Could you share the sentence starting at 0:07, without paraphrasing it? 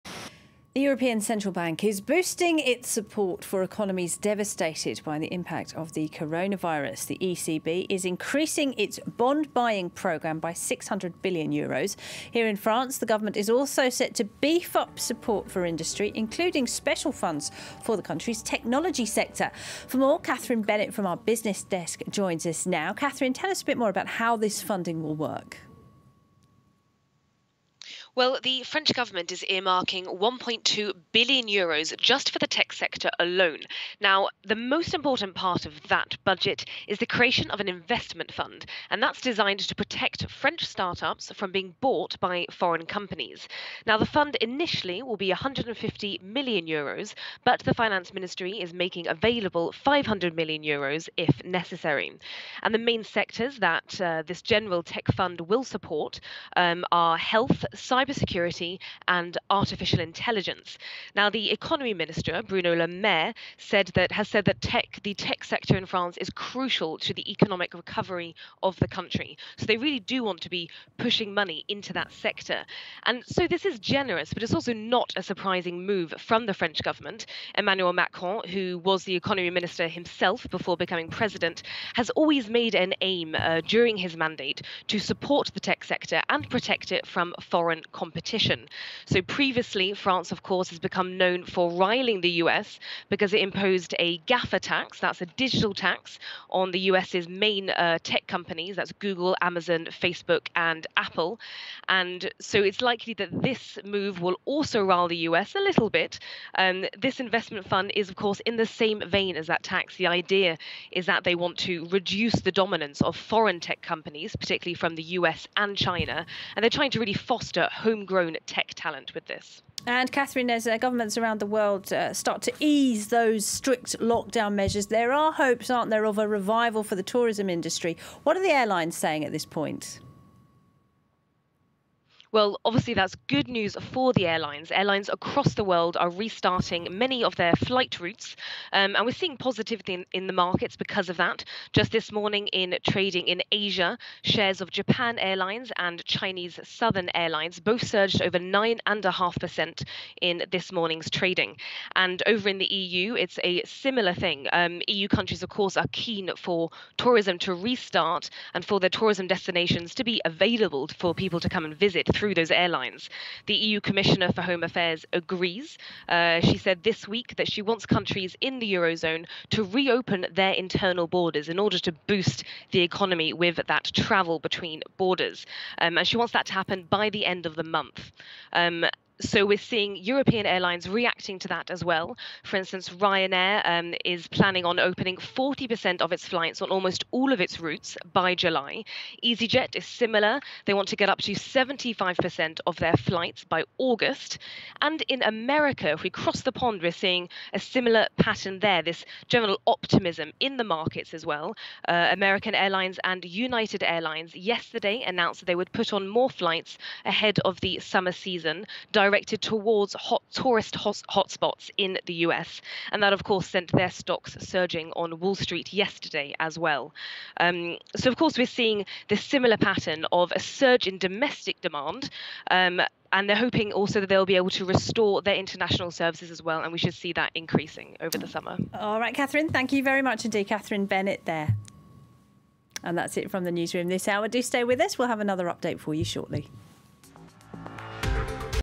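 The ECB is increasing its bond buying programme by 600 billion euros.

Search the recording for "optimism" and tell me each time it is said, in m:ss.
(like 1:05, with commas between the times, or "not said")
3:19.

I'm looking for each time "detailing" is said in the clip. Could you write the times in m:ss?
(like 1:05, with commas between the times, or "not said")
not said.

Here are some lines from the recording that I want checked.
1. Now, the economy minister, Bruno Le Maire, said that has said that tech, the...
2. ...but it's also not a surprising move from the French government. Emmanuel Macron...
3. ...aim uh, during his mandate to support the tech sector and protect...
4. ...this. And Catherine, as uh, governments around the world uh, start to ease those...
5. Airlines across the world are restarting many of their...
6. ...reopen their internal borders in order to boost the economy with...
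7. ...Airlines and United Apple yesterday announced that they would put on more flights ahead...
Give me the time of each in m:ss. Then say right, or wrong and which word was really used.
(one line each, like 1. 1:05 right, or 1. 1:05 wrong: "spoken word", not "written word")
1. 1:01 right
2. 1:14 right
3. 1:23 right
4. 1:59 right
5. 2:14 right
6. 2:49 right
7. 3:22 wrong: "Airlines", not "Apple".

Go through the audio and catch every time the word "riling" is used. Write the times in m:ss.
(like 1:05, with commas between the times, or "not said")
1:31.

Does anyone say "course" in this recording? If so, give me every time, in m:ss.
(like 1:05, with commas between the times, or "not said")
1:30, 1:48, 2:35, 3:33, 3:38.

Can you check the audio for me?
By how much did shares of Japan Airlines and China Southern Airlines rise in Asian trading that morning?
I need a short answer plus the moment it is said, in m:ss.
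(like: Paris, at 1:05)
over 9.5%, at 2:28.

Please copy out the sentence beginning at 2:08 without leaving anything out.
What are the airlines saying at this point?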